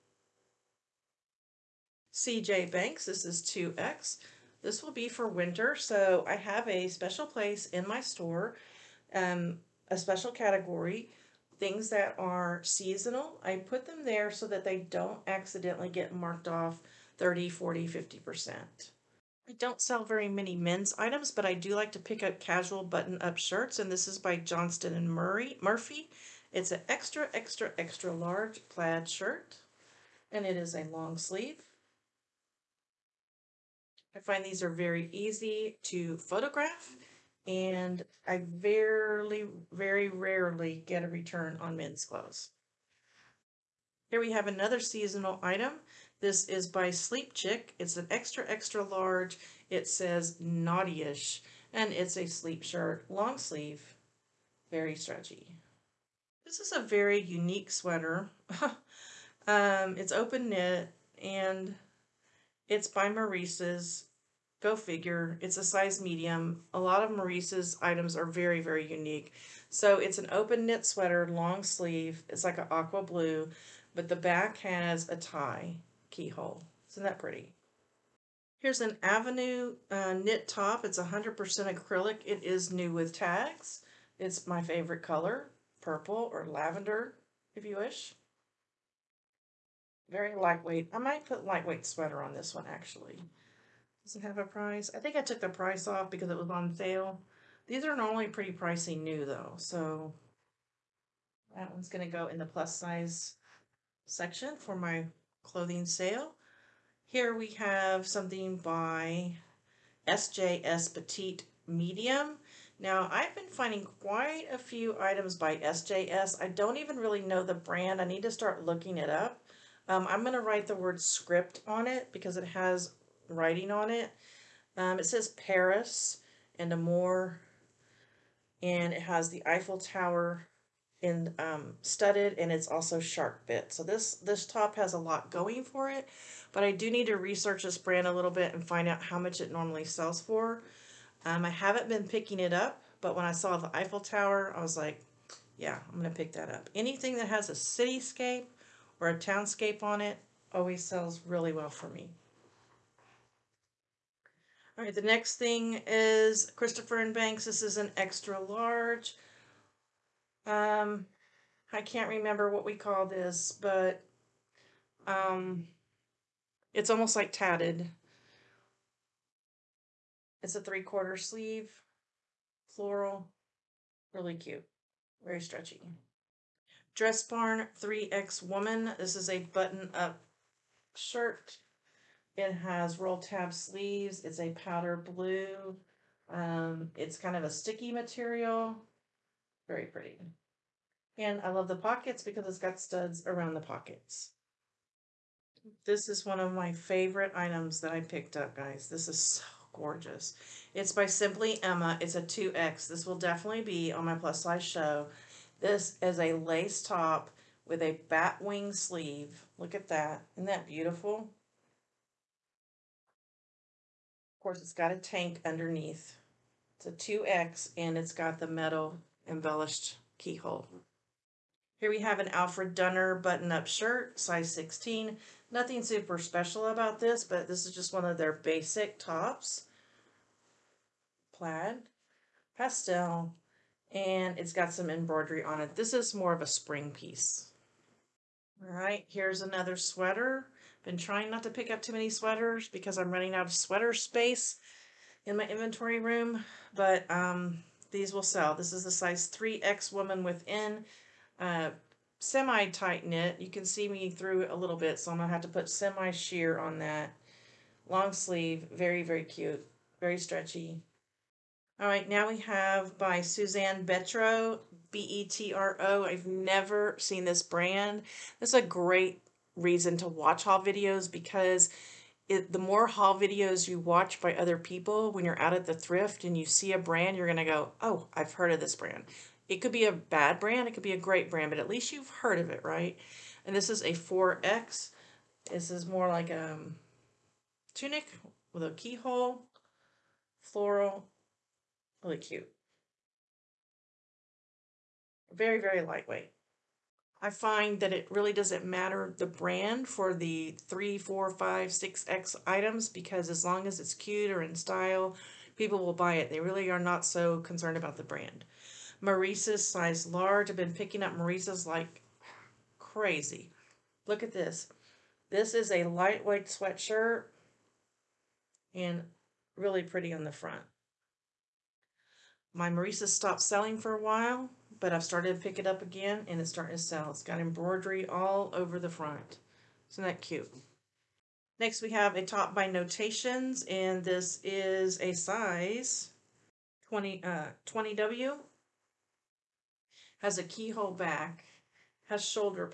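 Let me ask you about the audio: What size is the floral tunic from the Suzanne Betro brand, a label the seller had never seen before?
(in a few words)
4X.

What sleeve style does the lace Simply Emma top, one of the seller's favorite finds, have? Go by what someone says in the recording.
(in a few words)
bat wing sleeve.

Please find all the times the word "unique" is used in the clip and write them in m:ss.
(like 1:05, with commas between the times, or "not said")
0:57, 1:08.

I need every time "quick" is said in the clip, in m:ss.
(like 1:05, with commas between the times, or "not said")
not said.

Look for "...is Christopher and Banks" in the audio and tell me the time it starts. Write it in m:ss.
2:35.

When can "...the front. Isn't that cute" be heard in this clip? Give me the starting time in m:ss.
5:28.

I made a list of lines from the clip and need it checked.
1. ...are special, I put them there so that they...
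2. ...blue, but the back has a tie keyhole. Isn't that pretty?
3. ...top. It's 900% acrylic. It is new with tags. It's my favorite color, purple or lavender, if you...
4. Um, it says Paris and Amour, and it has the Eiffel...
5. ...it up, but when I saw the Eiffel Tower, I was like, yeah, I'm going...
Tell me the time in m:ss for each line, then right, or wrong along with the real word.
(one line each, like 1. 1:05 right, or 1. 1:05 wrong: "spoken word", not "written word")
1. 0:12 wrong: "seasonal", not "special"
2. 1:13 right
3. 1:20 wrong: "100", not "900"
4. 2:04 right
5. 2:22 right.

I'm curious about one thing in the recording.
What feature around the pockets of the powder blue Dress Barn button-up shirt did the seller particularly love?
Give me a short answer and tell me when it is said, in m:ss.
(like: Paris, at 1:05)
studs, at 3:12.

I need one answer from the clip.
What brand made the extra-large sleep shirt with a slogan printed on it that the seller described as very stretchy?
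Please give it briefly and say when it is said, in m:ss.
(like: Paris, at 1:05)
Sleep Chick, at 0:46.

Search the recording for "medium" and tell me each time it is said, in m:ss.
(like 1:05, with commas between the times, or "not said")
1:06, 1:51.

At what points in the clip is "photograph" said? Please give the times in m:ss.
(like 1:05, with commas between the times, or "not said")
0:36.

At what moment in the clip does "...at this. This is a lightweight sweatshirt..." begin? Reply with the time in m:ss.
5:14.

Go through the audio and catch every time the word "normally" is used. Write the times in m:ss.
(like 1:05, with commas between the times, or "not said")
1:37, 2:19.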